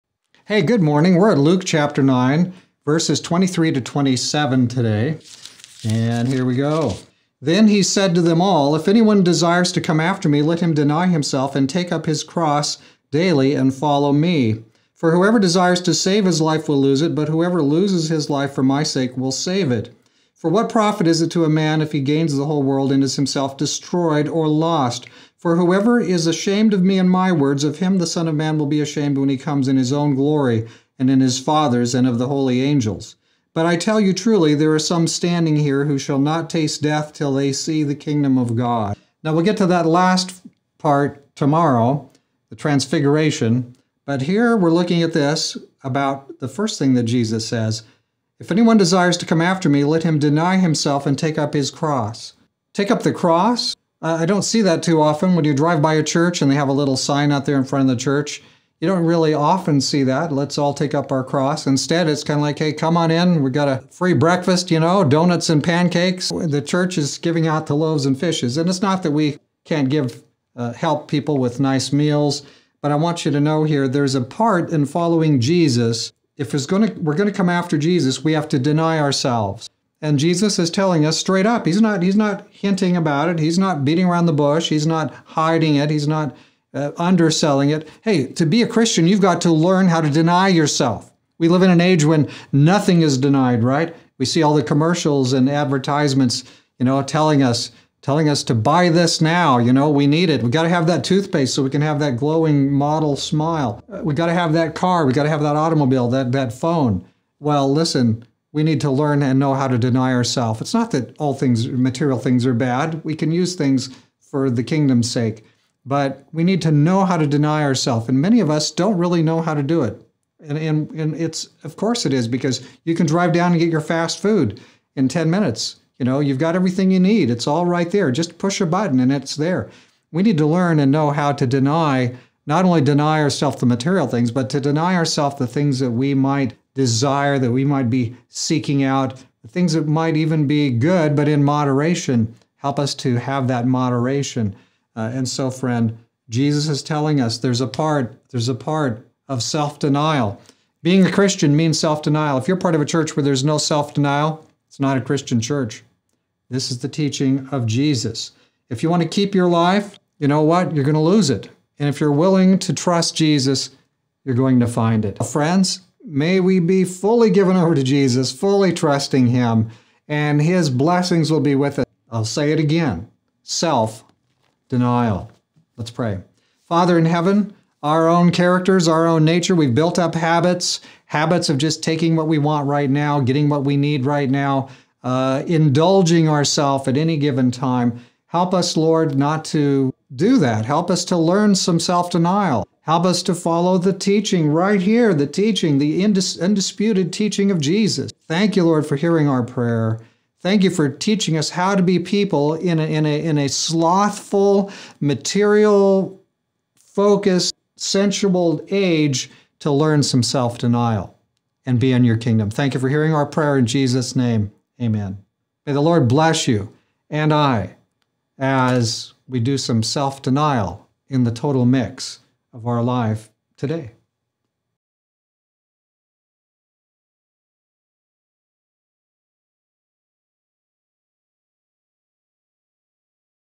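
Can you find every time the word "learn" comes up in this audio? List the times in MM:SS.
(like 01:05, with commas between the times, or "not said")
01:29, 01:48, 02:10, 03:11, 03:29.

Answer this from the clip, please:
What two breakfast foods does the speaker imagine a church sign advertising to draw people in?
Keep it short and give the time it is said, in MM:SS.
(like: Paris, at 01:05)
Donuts and pancakes, at 01:05.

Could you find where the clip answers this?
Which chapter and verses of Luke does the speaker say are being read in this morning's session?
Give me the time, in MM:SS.
00:01.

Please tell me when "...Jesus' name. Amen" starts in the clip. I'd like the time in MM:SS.
03:33.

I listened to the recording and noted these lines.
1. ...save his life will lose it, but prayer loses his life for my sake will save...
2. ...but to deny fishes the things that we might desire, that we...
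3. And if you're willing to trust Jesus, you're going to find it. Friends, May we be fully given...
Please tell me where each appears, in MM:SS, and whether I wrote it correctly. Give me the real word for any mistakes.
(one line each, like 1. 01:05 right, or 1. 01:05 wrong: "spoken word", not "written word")
1. 00:15 wrong: "whoever", not "prayer"
2. 02:14 wrong: "ourselves", not "fishes"
3. 02:41 right.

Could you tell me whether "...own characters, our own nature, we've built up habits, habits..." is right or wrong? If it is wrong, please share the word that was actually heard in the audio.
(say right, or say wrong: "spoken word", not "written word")
right.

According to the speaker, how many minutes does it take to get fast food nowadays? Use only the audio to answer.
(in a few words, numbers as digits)
10.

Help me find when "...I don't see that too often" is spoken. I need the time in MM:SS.
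00:54.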